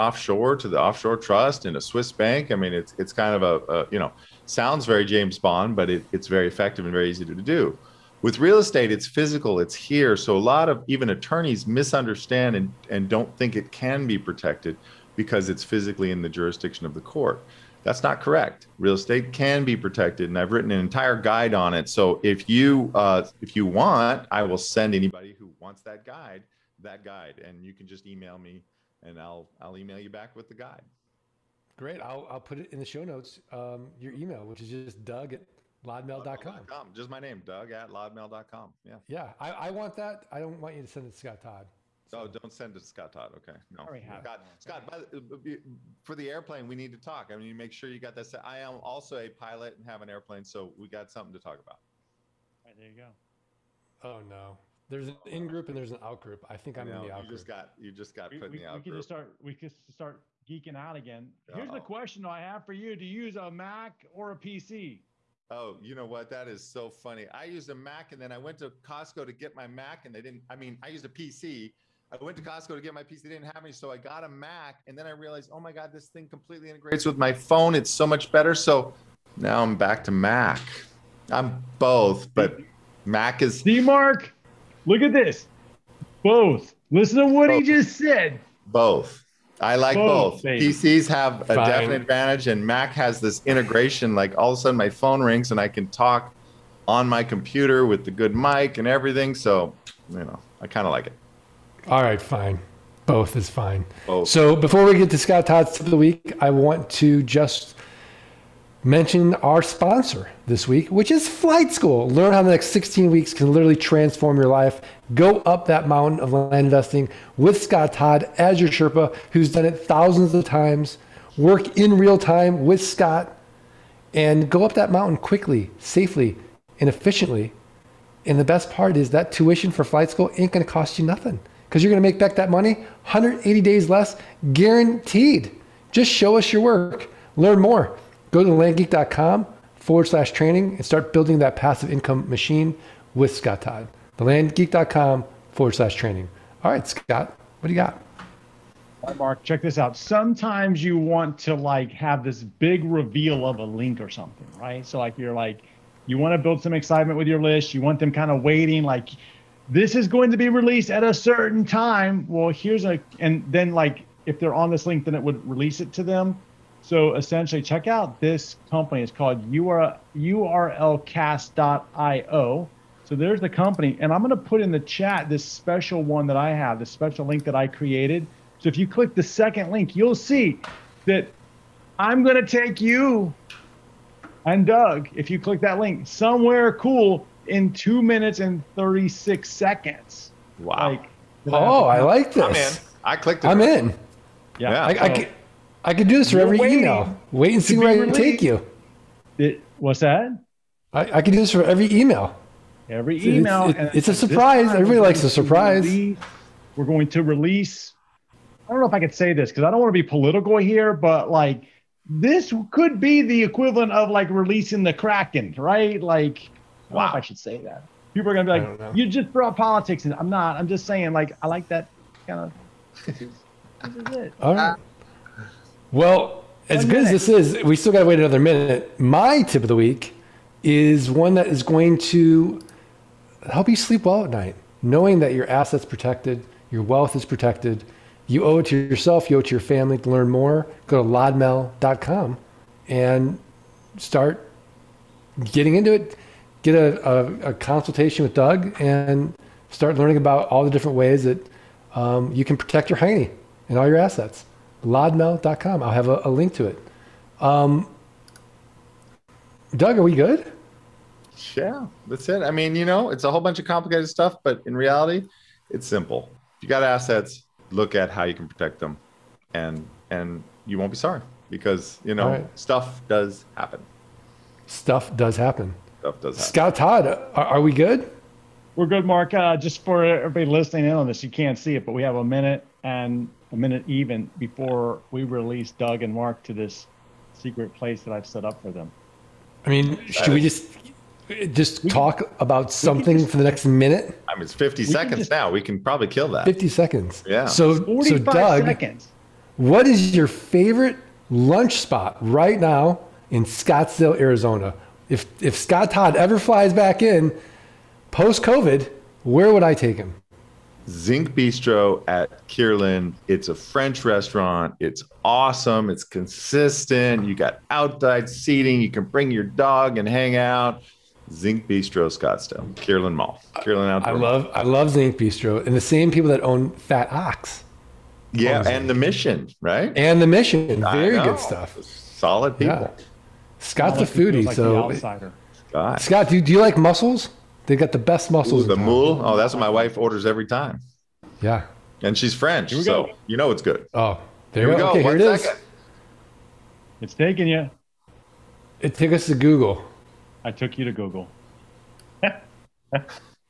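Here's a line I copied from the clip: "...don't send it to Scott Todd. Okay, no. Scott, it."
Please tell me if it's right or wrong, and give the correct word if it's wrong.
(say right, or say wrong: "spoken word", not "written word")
right.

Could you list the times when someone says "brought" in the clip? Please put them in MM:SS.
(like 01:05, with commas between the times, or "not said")
03:39.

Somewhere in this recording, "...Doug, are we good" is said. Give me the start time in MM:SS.
04:19.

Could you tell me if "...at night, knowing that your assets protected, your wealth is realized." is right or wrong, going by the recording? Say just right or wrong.
wrong.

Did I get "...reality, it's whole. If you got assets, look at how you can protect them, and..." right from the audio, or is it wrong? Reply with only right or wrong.
wrong.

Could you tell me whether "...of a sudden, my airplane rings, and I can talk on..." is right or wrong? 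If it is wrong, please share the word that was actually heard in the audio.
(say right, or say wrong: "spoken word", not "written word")
wrong: "phone", not "airplane".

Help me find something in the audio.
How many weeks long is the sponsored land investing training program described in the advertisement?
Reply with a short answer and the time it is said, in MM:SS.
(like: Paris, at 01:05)
16, at 01:52.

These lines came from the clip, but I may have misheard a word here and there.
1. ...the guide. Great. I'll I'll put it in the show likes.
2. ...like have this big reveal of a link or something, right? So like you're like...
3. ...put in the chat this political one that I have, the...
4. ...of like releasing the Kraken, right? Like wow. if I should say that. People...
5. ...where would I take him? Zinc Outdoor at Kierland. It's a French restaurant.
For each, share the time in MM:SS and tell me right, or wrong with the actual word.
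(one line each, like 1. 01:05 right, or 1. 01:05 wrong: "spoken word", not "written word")
1. 00:30 wrong: "notes", not "likes"
2. 02:31 right
3. 02:54 wrong: "special", not "political"
4. 03:33 right
5. 05:09 wrong: "Bistro", not "Outdoor".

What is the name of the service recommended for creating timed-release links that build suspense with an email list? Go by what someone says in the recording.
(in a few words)
urlcast.io.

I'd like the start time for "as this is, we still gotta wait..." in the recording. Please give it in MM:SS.
03:47.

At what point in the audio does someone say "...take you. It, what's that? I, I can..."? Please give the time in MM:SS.
03:18.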